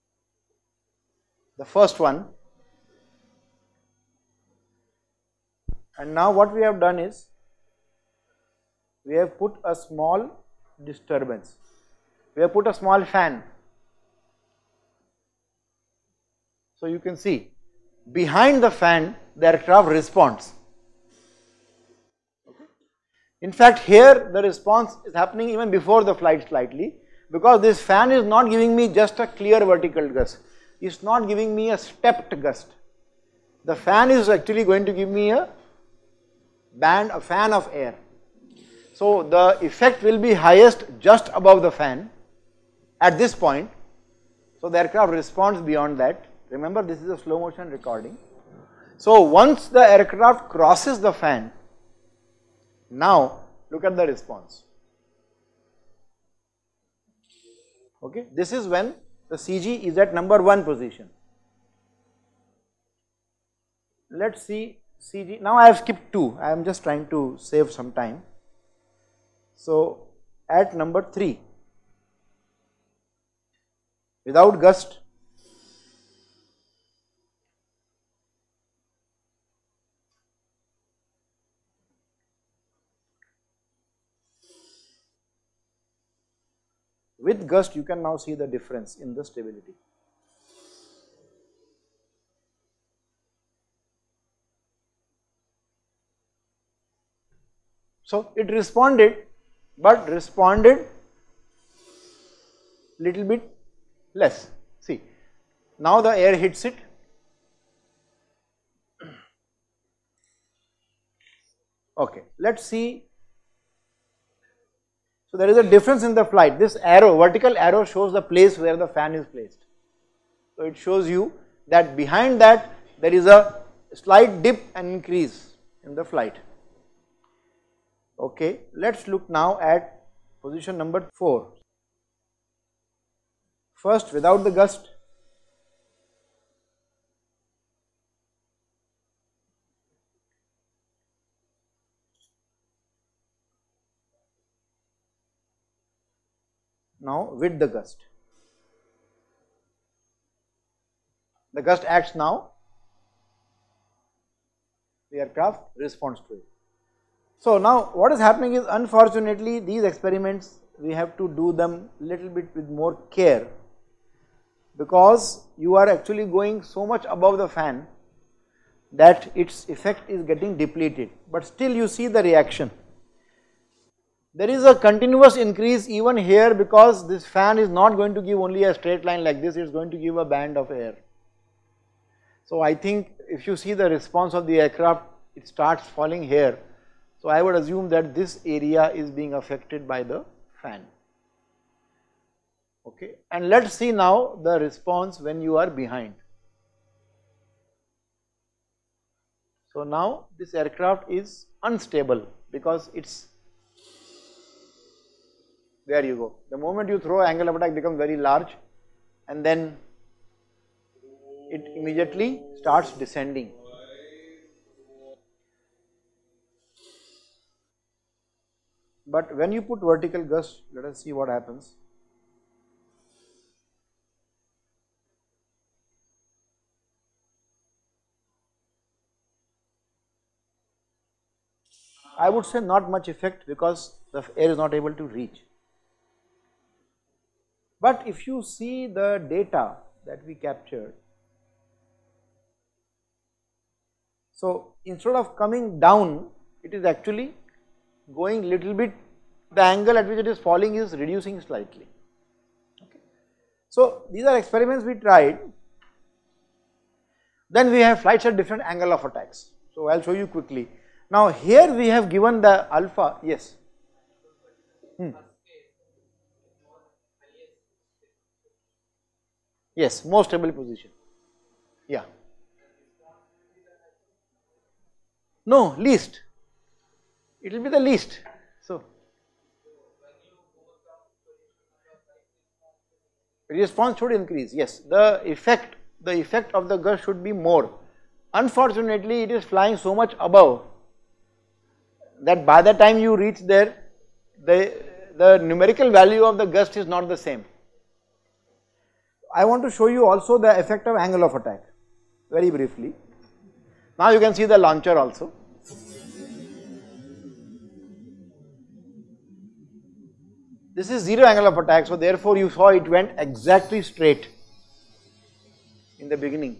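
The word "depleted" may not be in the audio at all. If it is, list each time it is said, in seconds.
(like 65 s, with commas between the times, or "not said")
170 s.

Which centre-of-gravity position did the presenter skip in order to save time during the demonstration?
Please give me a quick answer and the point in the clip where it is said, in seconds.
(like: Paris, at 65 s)
2, at 66 s.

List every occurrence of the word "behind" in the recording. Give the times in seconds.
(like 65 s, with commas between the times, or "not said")
18 s, 121 s, 195 s.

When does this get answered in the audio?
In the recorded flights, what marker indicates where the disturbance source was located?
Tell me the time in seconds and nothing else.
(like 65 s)
117 s.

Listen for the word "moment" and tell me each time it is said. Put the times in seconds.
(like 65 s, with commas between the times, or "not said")
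206 s.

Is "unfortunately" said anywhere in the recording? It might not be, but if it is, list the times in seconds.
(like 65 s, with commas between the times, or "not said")
158 s, 288 s.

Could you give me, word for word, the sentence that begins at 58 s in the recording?
Okay, this is when the CG is at number 1 position.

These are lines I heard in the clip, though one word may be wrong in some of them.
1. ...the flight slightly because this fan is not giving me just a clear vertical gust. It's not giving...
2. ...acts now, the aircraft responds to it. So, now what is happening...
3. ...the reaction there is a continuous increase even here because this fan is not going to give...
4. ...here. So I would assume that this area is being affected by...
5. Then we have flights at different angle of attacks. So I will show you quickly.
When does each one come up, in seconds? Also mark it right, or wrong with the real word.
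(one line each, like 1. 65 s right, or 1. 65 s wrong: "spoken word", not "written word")
1. 26 s right
2. 151 s right
3. 172 s right
4. 186 s right
5. 257 s right.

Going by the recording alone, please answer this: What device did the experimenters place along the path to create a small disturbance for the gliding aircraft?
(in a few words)
a small fan.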